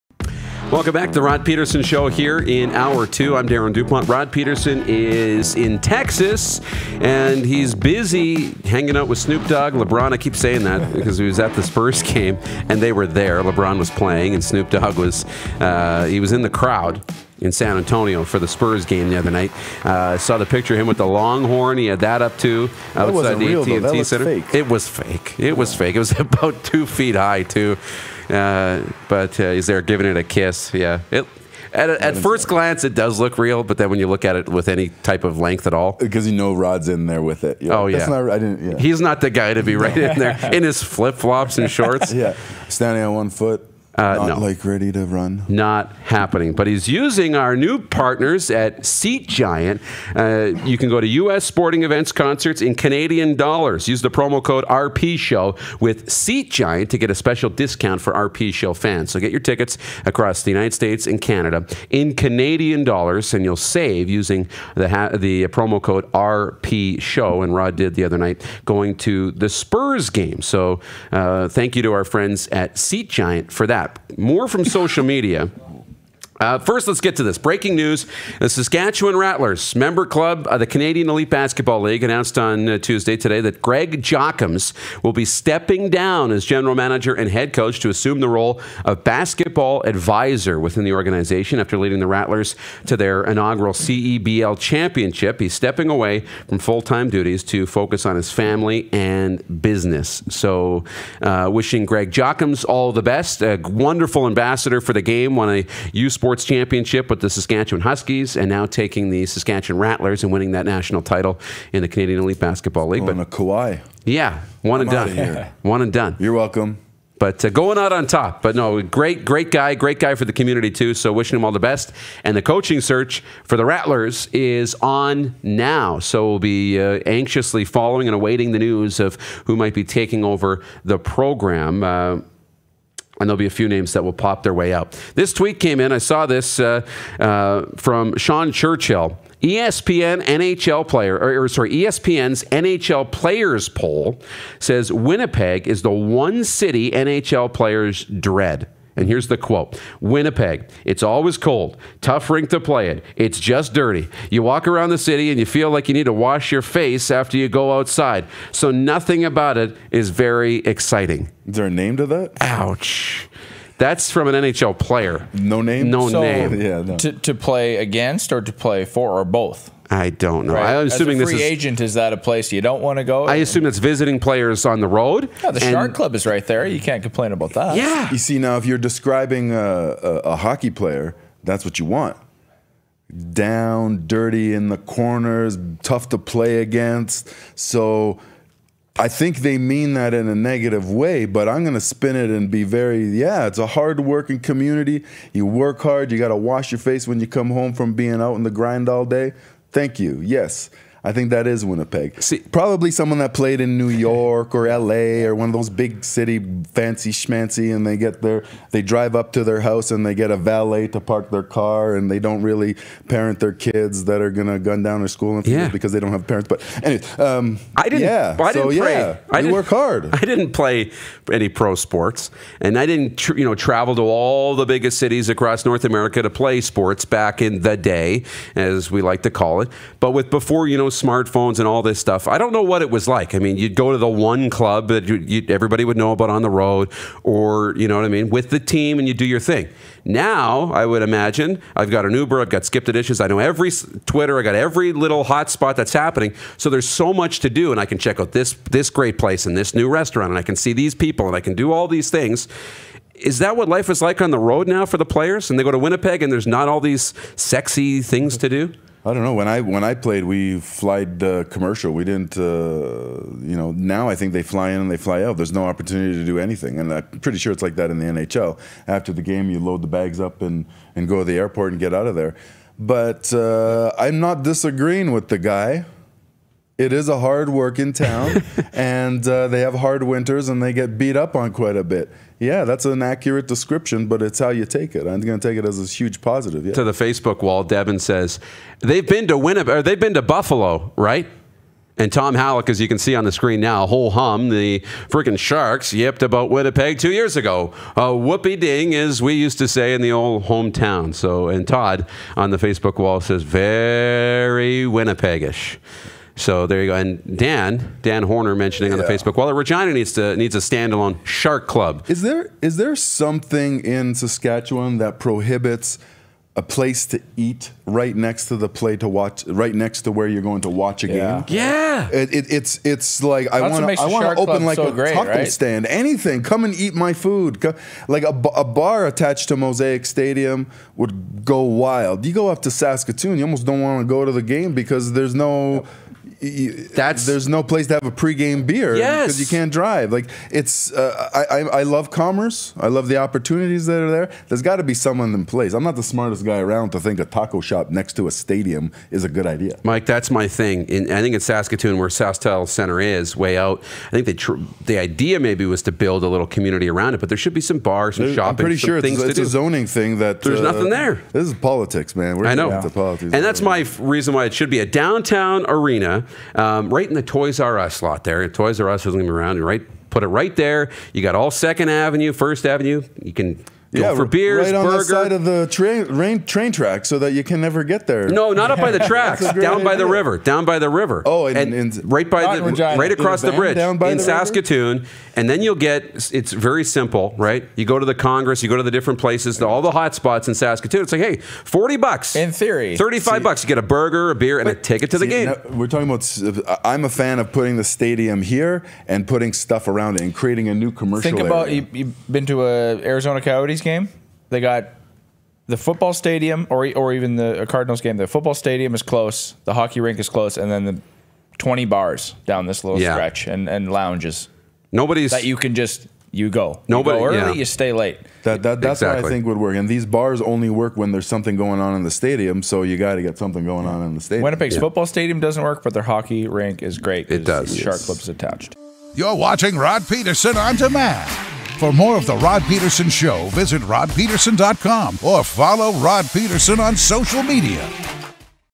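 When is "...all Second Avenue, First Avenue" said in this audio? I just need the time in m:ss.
6:11.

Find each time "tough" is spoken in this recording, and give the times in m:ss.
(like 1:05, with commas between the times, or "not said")
2:32, 3:05.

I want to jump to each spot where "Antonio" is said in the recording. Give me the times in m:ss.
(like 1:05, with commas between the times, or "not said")
0:17.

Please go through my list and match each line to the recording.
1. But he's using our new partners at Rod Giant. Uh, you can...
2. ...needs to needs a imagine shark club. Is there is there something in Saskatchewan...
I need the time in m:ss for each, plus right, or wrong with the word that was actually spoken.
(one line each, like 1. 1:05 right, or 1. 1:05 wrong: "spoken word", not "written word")
1. 0:46 wrong: "Seat", not "Rod"
2. 5:09 wrong: "standalone", not "imagine".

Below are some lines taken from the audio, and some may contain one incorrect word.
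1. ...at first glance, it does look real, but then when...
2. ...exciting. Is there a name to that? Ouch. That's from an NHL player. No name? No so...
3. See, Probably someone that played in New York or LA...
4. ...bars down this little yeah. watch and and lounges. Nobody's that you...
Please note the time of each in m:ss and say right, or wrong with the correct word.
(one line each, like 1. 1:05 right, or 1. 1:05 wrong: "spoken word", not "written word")
1. 0:31 right
2. 2:40 right
3. 3:22 right
4. 6:51 wrong: "stretch", not "watch".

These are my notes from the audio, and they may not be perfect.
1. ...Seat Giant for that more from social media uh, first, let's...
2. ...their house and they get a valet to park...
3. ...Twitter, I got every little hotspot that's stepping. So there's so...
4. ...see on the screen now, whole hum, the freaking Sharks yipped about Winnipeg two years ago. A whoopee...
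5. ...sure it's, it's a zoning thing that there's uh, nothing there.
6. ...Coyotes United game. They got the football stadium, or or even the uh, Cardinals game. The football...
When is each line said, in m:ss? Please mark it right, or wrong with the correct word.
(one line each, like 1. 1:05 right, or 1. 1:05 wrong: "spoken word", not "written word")
1. 1:12 right
2. 3:29 right
3. 4:04 wrong: "happening", not "stepping"
4. 4:52 right
5. 5:58 right
6. 6:43 wrong: "Yankees", not "United".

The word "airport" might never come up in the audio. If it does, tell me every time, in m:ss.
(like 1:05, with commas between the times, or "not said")
4:31.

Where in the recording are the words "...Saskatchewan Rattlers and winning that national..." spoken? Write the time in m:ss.
1:49.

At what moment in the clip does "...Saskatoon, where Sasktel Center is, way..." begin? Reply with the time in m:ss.
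5:51.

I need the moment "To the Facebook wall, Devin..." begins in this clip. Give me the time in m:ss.
4:46.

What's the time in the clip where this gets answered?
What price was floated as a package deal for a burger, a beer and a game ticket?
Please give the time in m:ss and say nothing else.
6:31.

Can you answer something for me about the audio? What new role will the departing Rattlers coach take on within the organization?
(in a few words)
basketball advisor.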